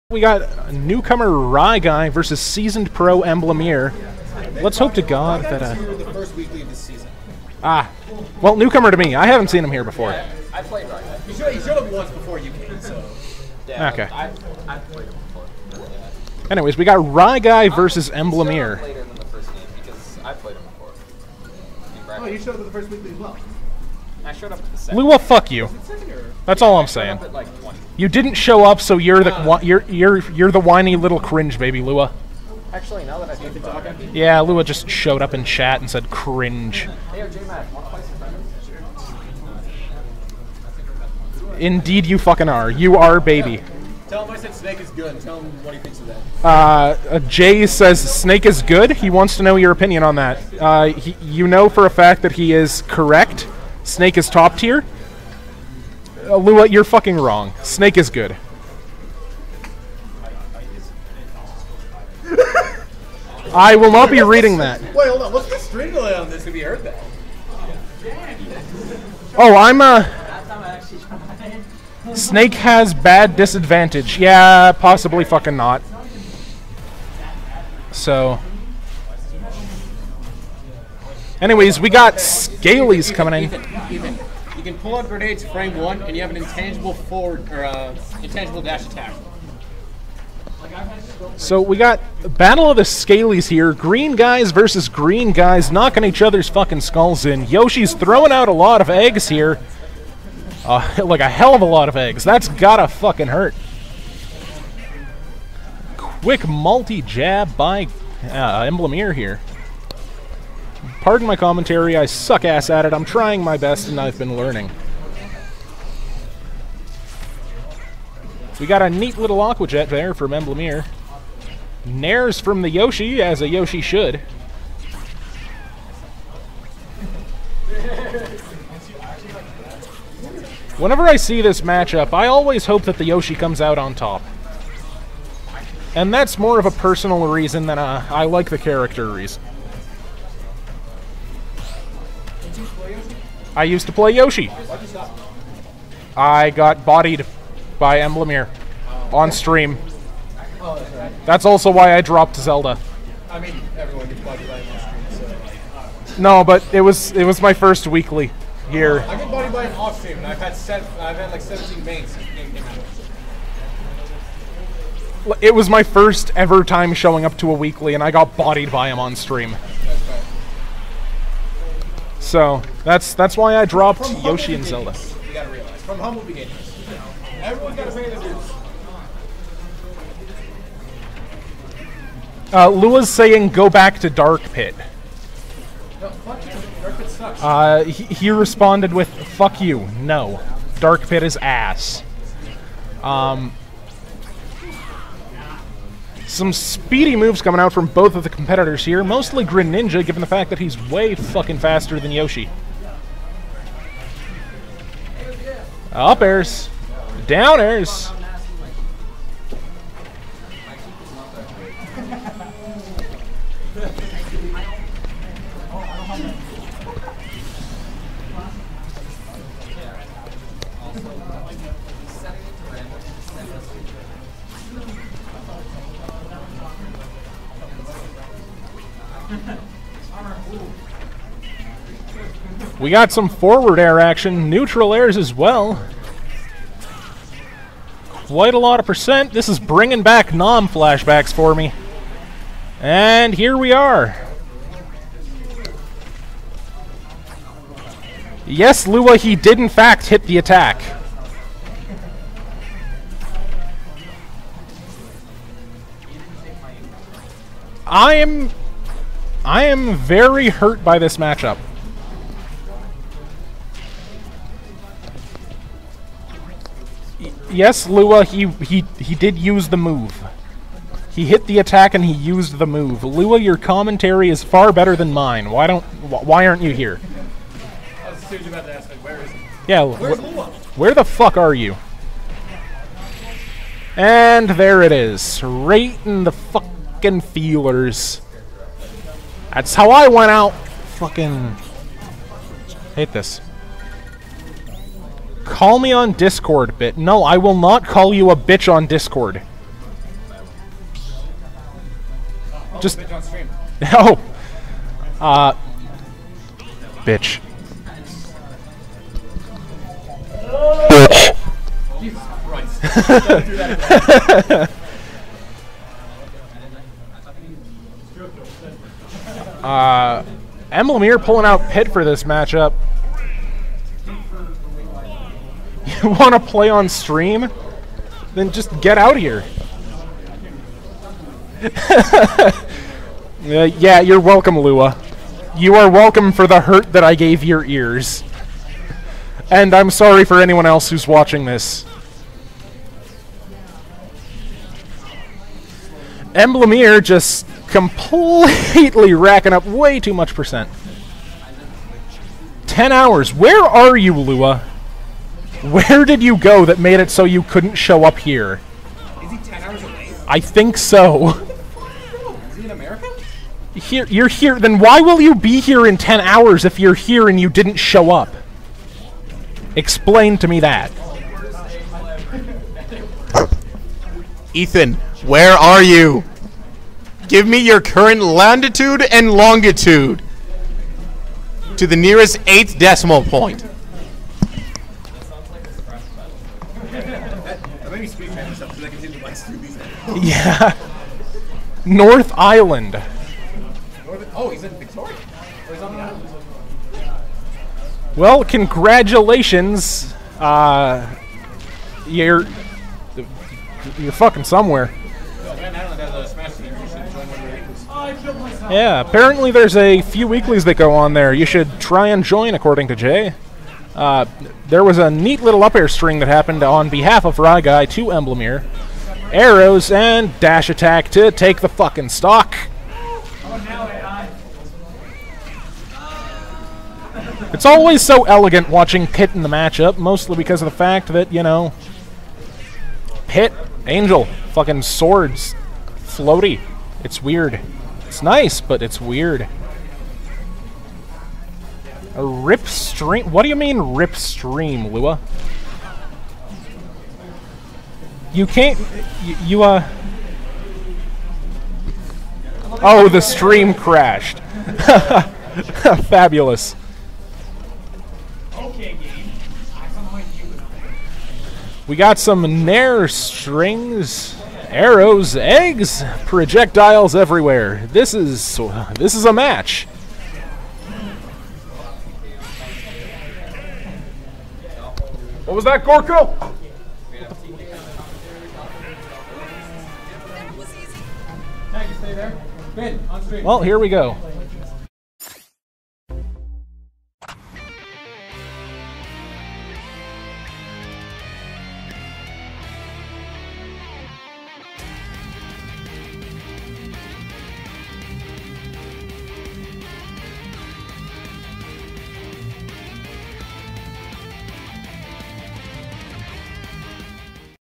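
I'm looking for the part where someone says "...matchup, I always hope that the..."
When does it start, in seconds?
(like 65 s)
131 s.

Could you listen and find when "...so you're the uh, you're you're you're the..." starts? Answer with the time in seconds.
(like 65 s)
28 s.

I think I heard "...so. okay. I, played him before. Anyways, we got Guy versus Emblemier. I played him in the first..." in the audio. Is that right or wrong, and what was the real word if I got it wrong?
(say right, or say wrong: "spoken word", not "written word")
right.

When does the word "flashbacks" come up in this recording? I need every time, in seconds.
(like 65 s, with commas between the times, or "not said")
240 s.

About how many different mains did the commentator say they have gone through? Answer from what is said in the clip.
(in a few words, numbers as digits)
17.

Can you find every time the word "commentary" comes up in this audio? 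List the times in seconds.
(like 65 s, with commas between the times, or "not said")
111 s, 273 s.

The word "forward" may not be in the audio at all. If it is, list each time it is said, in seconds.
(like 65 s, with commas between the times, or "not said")
86 s, 233 s.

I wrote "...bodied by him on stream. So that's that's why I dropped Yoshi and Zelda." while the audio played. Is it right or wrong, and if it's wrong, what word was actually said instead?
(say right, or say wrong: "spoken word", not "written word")
right.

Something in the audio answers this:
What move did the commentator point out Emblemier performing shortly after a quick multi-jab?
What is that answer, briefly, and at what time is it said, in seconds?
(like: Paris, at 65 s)
Aqua Jet, at 119 s.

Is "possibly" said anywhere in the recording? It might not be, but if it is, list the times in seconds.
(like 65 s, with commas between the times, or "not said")
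74 s.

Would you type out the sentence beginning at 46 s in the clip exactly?
Uh, uh, Jay says Snake is good.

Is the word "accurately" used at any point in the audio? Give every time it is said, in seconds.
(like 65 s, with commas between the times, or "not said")
not said.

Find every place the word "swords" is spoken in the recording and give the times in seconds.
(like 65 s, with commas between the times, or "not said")
434 s.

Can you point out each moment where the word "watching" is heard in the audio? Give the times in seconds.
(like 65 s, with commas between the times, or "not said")
341 s, 428 s.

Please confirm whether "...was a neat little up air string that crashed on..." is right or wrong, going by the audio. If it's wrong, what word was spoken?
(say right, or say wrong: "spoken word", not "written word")
wrong: "happened", not "crashed".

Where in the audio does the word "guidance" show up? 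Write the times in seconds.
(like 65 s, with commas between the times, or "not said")
not said.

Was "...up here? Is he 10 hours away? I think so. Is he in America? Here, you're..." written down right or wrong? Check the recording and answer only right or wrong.
right.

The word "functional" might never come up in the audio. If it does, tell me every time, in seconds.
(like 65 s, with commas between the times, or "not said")
not said.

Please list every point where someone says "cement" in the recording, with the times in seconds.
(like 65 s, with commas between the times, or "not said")
not said.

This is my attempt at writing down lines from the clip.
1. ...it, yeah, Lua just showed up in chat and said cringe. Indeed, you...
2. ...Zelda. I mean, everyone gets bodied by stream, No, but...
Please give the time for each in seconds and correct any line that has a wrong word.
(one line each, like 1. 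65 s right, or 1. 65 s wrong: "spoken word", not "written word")
1. 33 s right
2. 152 s right.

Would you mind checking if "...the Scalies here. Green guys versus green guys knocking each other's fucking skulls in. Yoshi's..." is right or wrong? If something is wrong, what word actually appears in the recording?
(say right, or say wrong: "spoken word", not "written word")
right.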